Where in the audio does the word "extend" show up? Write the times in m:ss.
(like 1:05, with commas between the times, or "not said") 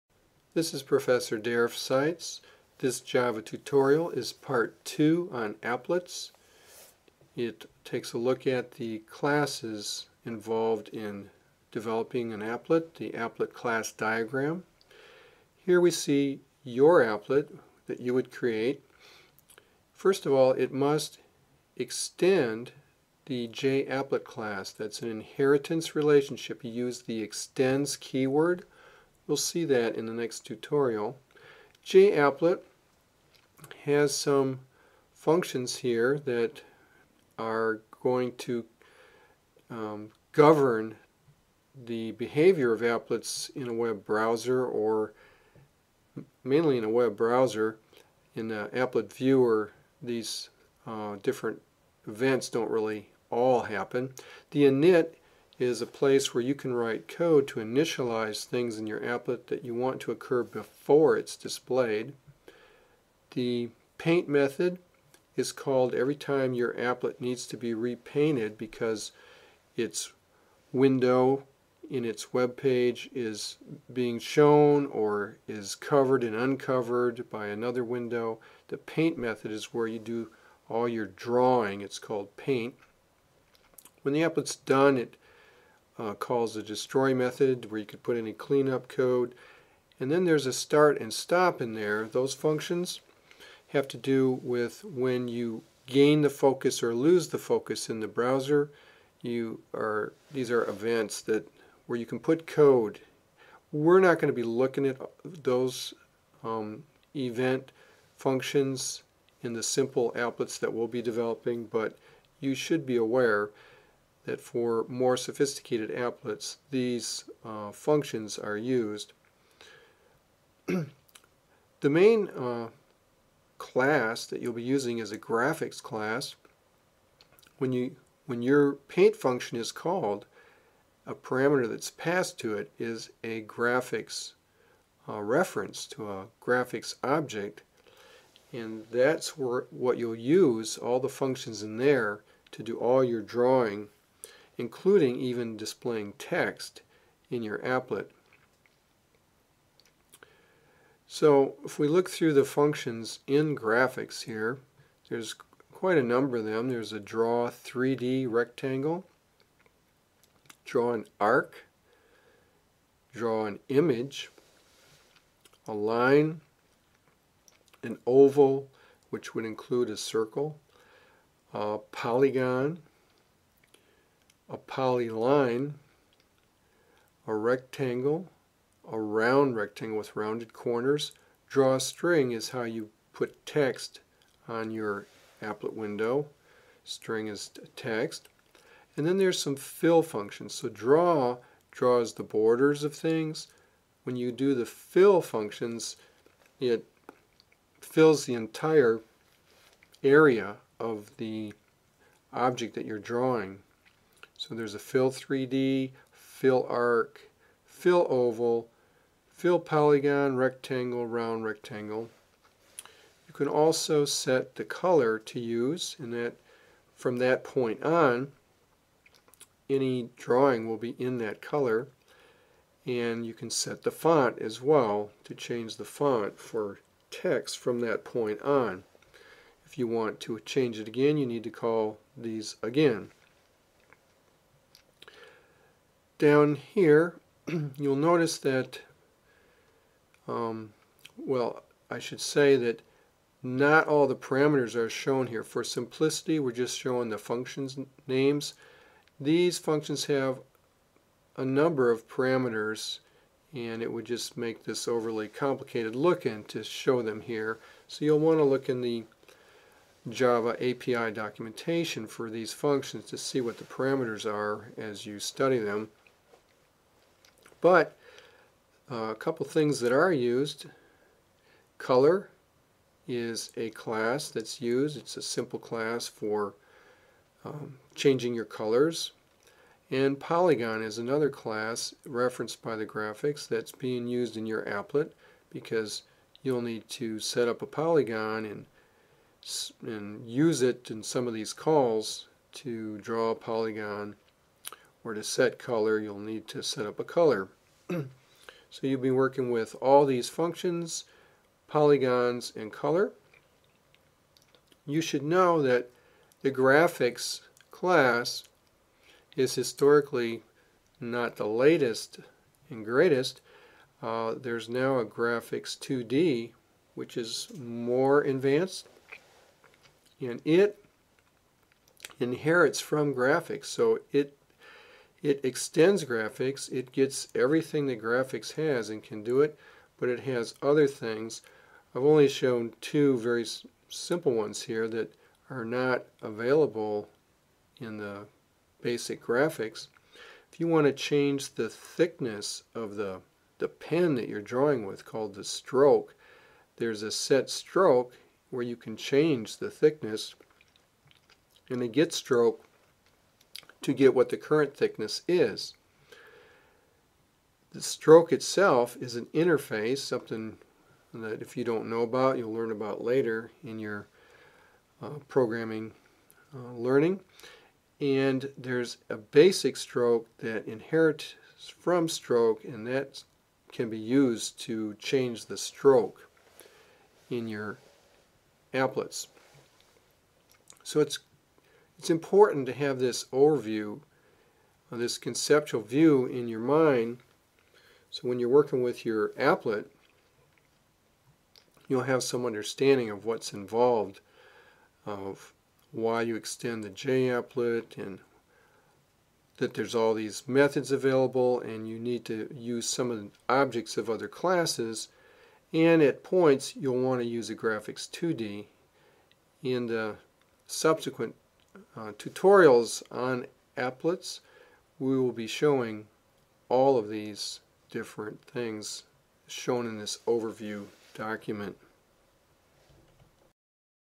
0:21, 0:27, 5:25, 6:36.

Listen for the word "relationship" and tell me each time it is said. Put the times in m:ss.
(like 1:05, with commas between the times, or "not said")
0:25.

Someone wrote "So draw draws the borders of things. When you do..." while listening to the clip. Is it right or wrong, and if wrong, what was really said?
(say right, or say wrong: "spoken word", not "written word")
right.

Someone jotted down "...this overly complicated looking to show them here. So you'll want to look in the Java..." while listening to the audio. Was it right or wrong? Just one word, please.
right.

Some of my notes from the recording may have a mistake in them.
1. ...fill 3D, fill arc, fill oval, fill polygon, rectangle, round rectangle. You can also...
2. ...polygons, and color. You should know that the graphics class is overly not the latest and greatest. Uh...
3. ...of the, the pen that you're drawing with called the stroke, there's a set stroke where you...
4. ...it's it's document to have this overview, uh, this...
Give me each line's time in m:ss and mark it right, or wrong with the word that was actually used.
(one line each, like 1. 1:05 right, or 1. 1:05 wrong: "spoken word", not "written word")
1. 3:24 right
2. 5:01 wrong: "historically", not "overly"
3. 5:42 right
4. 6:20 wrong: "important", not "document".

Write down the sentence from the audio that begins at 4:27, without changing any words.
But uh, a couple things that are used.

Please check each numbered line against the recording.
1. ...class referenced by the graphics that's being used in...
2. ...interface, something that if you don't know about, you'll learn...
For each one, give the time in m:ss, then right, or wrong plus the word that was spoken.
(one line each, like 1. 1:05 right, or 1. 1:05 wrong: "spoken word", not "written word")
1. 4:41 right
2. 5:59 right.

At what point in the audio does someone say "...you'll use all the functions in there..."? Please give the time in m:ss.
2:19.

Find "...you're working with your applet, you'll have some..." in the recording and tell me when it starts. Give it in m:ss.
6:28.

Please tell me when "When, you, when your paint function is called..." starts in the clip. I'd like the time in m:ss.
2:07.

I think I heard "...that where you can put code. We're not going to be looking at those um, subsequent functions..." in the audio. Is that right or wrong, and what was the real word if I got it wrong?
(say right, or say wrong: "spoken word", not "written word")
wrong: "event", not "subsequent".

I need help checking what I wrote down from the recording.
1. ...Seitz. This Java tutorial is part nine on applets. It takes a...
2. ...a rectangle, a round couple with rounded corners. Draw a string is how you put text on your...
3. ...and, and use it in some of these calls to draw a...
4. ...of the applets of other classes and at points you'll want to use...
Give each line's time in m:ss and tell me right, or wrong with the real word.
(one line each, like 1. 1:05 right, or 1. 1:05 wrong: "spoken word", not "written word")
1. 0:01 wrong: "two", not "nine"
2. 2:57 wrong: "rectangle", not "couple"
3. 4:48 right
4. 6:43 wrong: "objects", not "applets".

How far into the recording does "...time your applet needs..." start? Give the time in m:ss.
1:06.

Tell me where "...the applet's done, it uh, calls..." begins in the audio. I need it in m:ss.
1:24.